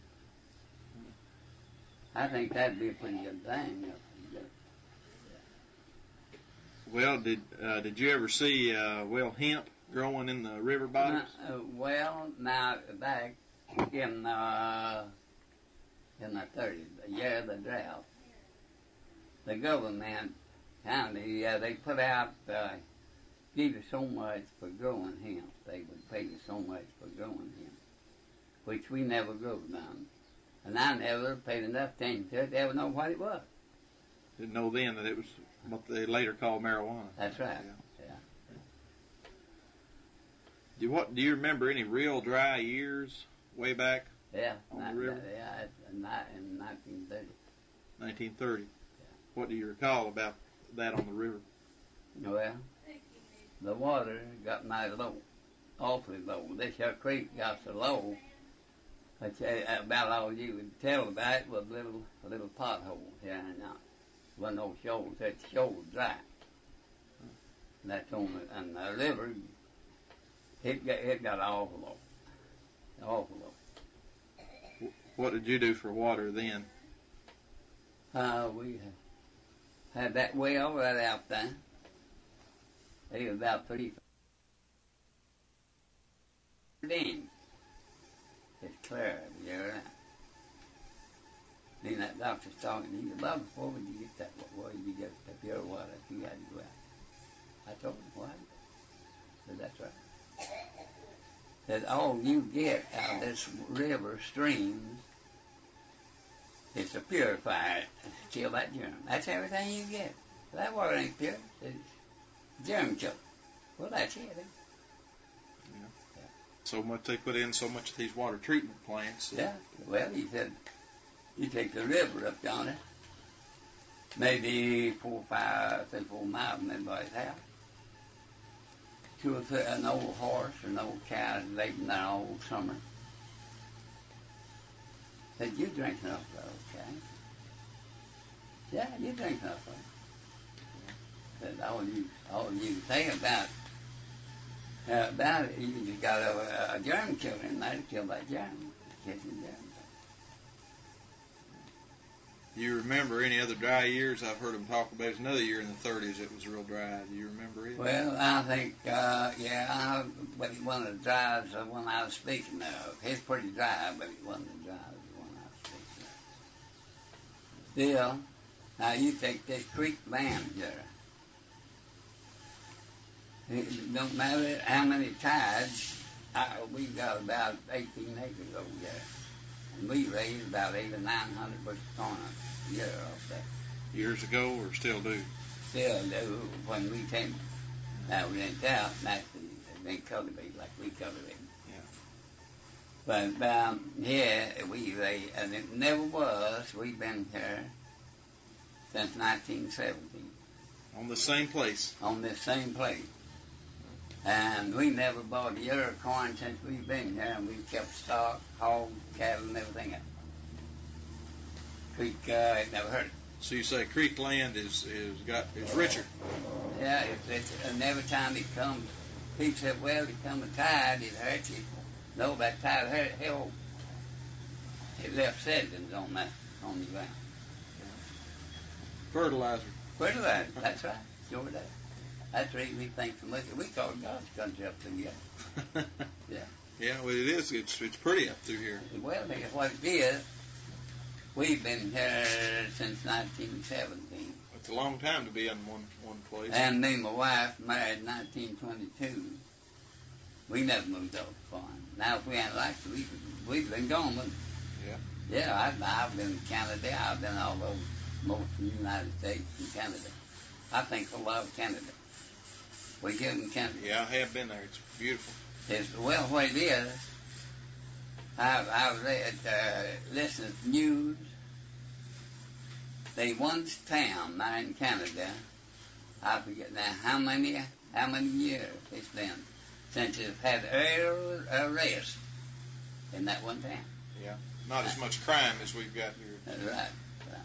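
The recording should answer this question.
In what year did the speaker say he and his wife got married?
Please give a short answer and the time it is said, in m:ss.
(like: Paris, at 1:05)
1922, at 4:08.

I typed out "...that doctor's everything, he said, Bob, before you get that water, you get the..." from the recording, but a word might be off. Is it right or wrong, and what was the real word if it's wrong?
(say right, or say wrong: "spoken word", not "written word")
wrong: "talking", not "everything".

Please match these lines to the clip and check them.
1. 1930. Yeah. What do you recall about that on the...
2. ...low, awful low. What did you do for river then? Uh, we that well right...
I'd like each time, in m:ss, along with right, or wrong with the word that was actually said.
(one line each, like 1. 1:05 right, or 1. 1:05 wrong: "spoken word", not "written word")
1. 0:47 right
2. 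1:13 wrong: "water", not "river".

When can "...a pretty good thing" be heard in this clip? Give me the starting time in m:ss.
0:02.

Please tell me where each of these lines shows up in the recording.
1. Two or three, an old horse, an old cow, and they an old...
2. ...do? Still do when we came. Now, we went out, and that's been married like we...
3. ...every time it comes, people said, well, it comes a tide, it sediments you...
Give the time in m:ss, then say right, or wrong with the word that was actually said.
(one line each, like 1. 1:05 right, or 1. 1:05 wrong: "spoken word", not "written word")
1. 2:09 right
2. 3:05 wrong: "cultivated", not "married"
3. 3:37 wrong: "hurts", not "sediments".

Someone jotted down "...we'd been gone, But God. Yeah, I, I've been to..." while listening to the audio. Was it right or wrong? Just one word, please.
wrong.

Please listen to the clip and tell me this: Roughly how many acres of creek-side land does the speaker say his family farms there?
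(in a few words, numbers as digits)
18 acres.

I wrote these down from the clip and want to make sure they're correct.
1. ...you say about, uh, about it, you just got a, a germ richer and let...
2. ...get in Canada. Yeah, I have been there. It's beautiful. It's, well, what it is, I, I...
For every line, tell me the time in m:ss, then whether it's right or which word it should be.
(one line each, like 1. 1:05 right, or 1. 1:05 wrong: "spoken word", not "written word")
1. 2:22 wrong: "killer", not "richer"
2. 4:23 right.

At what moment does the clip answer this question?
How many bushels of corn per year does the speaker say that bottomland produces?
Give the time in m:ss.
3:00.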